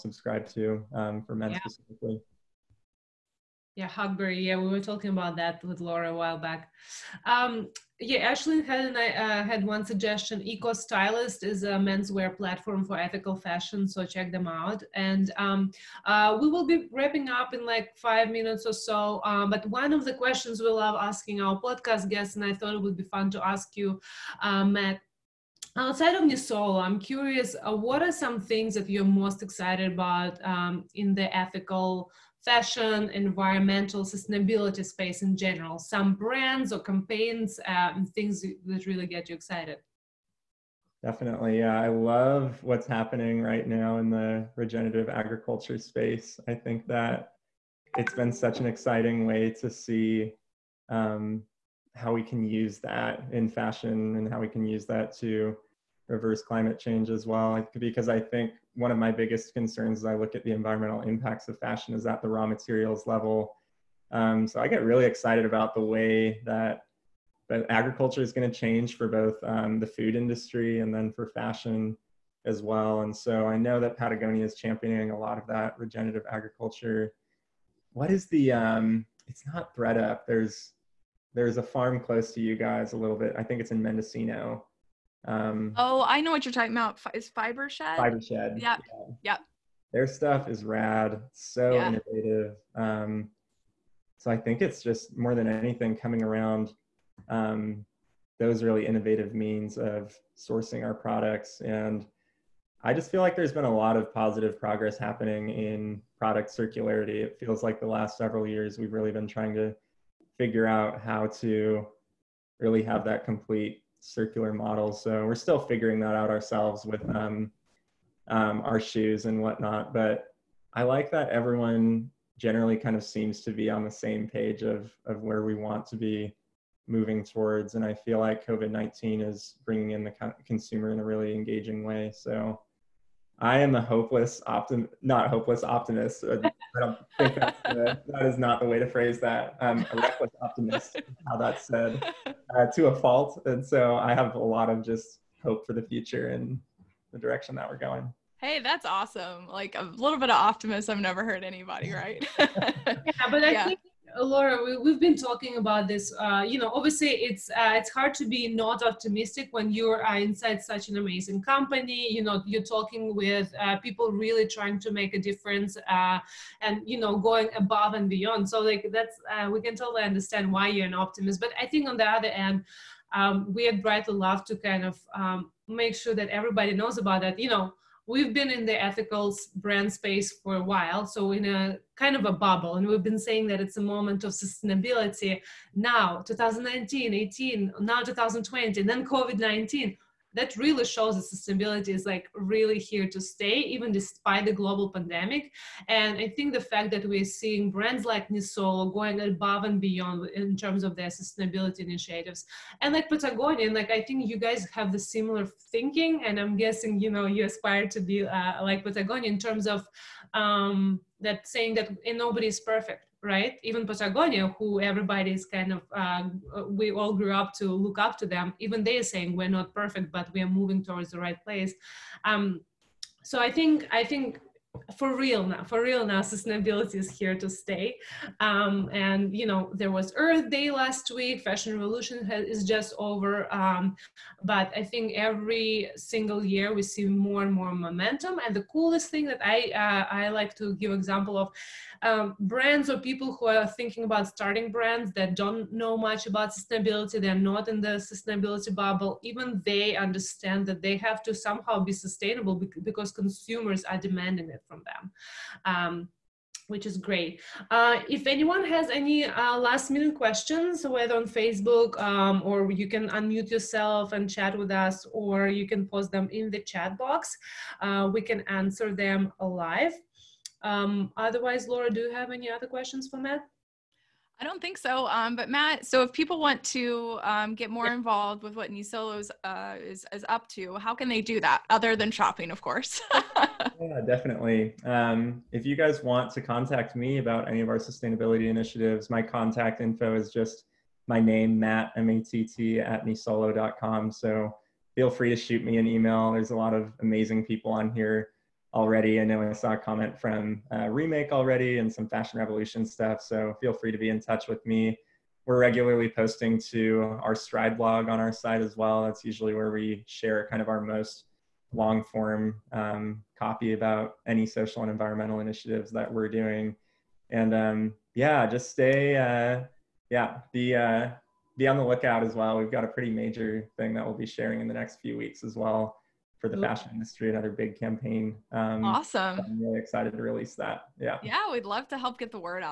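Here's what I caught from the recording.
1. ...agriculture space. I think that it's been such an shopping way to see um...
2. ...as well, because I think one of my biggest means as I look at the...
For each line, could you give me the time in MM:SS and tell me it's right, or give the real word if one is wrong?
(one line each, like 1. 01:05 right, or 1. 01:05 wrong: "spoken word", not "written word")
1. 00:45 wrong: "exciting", not "shopping"
2. 00:57 wrong: "concerns", not "means".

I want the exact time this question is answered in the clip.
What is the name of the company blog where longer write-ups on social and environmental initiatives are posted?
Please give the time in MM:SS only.
05:07.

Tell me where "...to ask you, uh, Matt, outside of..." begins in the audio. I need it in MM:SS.
00:23.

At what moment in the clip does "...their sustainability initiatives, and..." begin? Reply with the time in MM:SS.
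03:20.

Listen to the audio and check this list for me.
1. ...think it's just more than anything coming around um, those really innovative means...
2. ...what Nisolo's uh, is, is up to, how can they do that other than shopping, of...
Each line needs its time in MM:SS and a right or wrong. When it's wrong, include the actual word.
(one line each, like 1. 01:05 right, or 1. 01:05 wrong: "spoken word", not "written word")
1. 01:34 right
2. 04:38 right.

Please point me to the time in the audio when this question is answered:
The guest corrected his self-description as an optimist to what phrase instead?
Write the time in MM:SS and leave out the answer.
02:19.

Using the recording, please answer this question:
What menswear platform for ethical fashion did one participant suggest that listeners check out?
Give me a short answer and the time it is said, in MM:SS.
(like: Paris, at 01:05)
Eco Stylist, at 00:10.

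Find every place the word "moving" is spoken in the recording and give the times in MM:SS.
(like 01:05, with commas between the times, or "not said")
02:06, 03:40.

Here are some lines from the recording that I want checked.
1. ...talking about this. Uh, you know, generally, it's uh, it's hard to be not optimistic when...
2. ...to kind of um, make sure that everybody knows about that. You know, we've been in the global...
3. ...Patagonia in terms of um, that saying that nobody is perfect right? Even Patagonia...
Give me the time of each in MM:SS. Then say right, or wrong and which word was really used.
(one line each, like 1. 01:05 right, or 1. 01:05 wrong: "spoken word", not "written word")
1. 02:35 wrong: "obviously", not "generally"
2. 02:54 wrong: "ethical", not "global"
3. 03:28 right.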